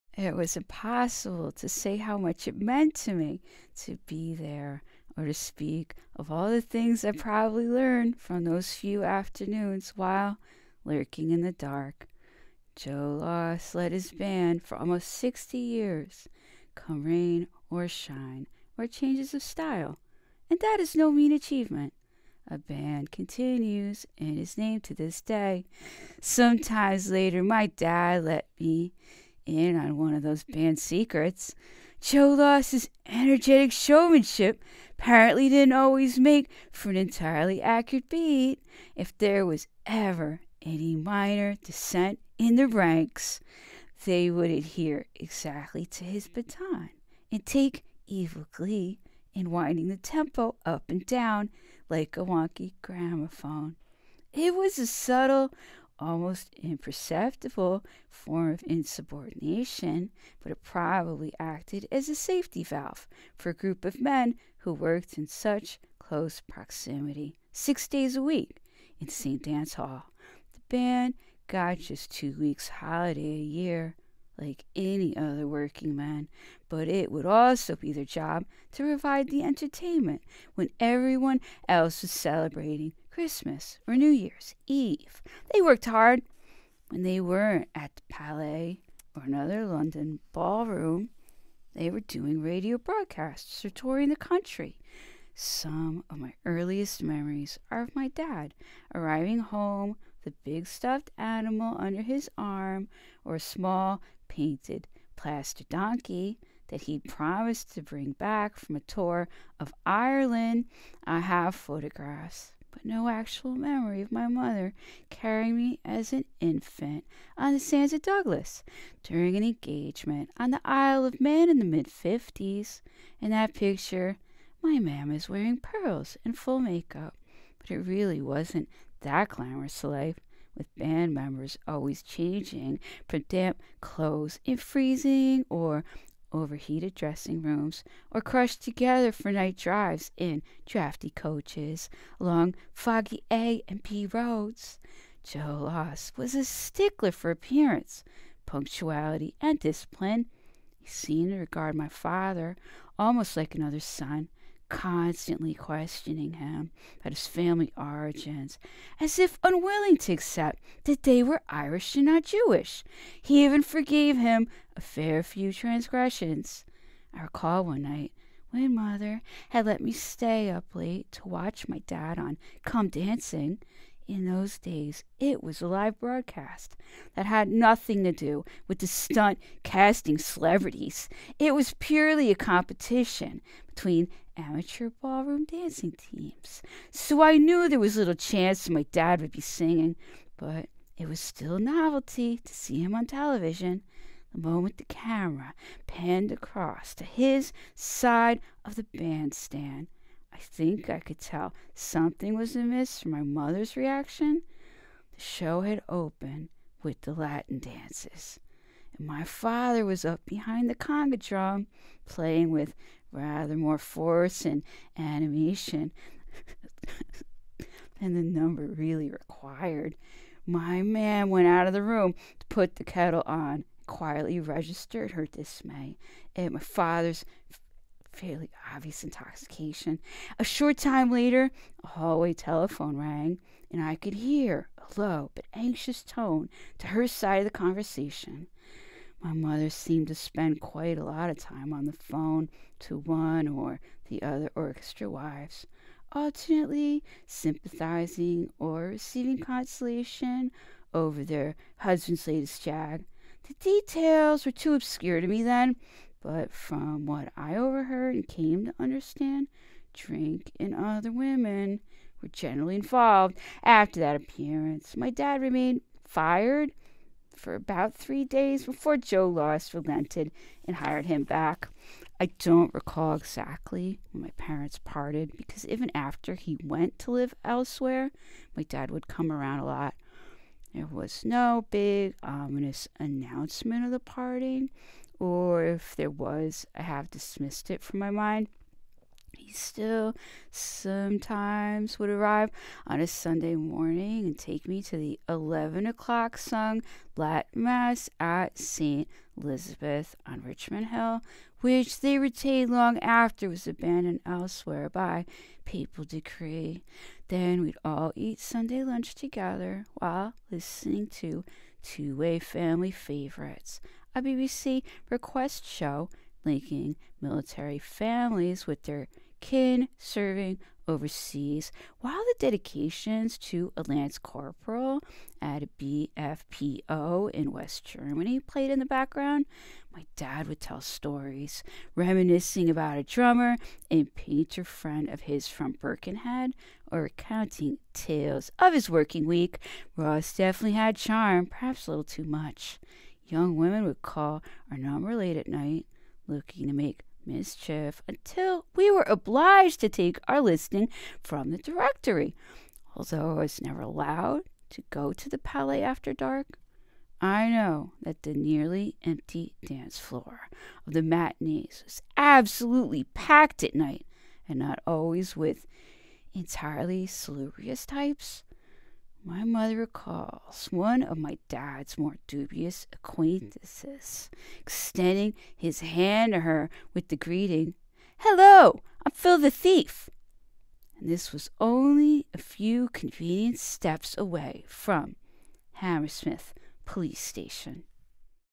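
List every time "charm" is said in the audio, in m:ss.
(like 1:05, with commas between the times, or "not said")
5:40.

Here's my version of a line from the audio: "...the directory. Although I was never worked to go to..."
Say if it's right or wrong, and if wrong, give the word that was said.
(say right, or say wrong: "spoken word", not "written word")
wrong: "allowed", not "worked".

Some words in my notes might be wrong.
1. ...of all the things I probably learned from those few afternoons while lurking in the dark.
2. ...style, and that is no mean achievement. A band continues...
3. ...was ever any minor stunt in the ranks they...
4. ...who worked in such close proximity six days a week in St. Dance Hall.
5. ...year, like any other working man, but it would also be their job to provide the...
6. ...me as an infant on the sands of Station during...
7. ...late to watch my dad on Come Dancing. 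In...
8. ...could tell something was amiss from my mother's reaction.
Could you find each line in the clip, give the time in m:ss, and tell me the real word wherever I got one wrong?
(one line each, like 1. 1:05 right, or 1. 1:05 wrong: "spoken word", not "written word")
1. 0:06 right
2. 0:19 right
3. 0:39 wrong: "dissent", not "stunt"
4. 1:04 right
5. 1:13 right
6. 1:55 wrong: "Douglas", not "Station"
7. 2:50 right
8. 3:20 right.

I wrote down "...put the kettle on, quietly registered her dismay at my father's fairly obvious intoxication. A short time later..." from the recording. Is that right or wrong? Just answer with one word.
right.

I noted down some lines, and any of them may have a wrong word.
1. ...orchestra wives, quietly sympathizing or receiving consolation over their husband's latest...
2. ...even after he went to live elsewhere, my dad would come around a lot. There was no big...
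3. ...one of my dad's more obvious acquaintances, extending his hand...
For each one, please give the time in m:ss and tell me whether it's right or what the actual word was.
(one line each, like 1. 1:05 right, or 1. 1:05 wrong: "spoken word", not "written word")
1. 4:04 wrong: "alternately", not "quietly"
2. 4:35 right
3. 6:10 wrong: "dubious", not "obvious".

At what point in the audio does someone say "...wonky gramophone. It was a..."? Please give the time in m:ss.
0:52.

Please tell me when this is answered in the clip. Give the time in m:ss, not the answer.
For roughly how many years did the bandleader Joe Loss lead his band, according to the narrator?
0:14.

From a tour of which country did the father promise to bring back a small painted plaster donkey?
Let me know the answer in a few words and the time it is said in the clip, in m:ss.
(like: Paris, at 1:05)
Ireland, at 1:49.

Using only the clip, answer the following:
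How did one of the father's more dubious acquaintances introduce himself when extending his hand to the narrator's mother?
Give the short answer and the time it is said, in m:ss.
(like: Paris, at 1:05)
Phil the Thief, at 6:19.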